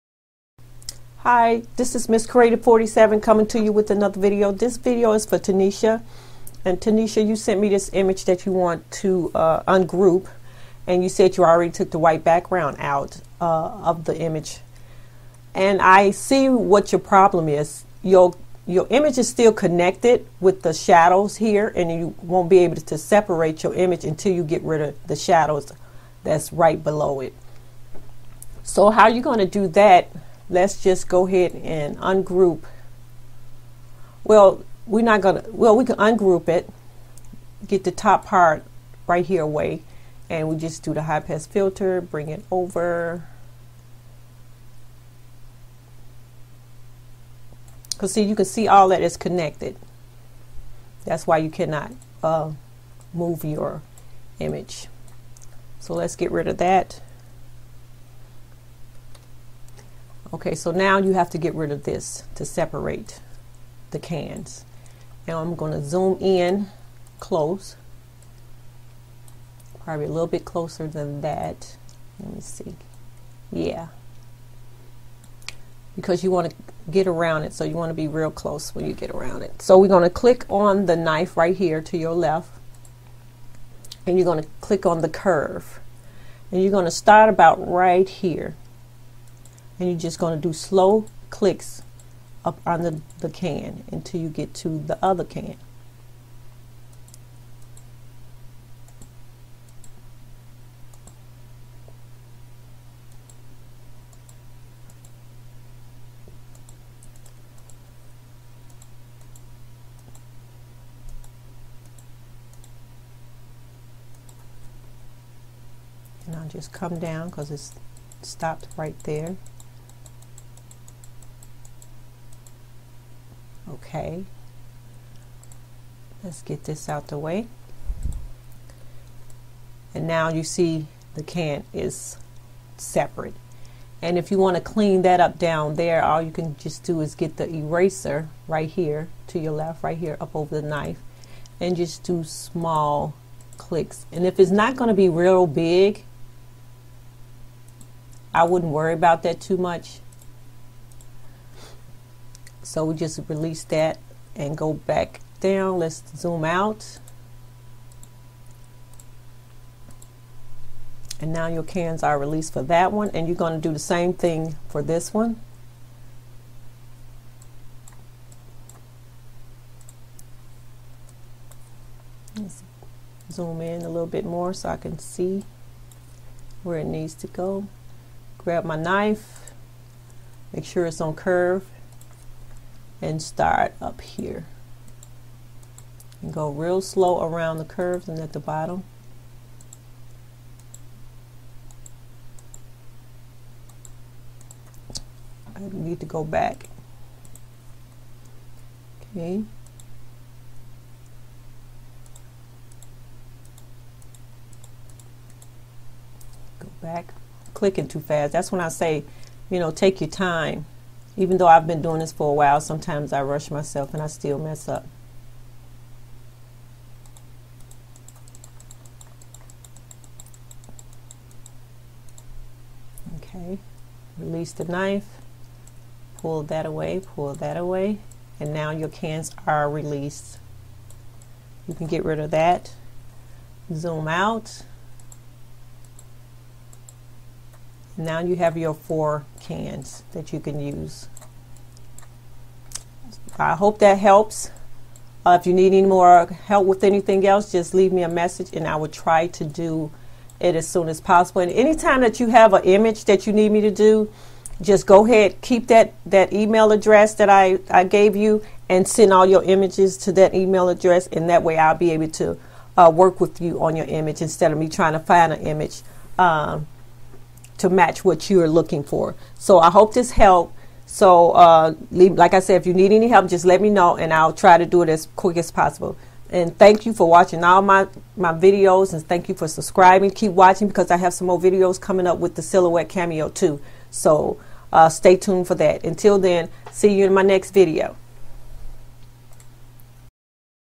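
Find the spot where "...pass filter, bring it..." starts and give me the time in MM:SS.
00:41.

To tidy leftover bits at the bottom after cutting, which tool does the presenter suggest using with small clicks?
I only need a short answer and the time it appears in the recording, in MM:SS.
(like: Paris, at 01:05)
eraser, at 02:17.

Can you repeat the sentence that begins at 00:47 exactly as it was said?
Because see, you can see all that is connected.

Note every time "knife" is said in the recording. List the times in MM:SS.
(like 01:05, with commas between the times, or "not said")
01:20, 02:20, 02:58, 03:44.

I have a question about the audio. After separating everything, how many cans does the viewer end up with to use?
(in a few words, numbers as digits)
4.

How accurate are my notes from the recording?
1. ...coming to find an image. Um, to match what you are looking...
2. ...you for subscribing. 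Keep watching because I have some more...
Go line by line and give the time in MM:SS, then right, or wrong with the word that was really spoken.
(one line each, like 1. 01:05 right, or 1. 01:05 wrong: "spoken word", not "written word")
1. 04:24 wrong: "trying", not "coming"
2. 04:39 right.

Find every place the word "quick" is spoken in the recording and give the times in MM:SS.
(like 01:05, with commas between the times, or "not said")
04:35.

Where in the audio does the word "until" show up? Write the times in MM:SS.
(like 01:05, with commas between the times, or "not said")
00:24, 01:33, 04:45.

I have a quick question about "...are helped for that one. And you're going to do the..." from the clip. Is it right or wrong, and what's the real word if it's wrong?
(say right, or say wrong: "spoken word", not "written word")
wrong: "released", not "helped".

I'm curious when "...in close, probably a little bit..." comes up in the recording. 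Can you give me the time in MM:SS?
01:06.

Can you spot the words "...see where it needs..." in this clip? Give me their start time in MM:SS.
02:54.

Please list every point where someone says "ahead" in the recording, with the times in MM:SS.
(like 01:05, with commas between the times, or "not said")
00:31, 04:15.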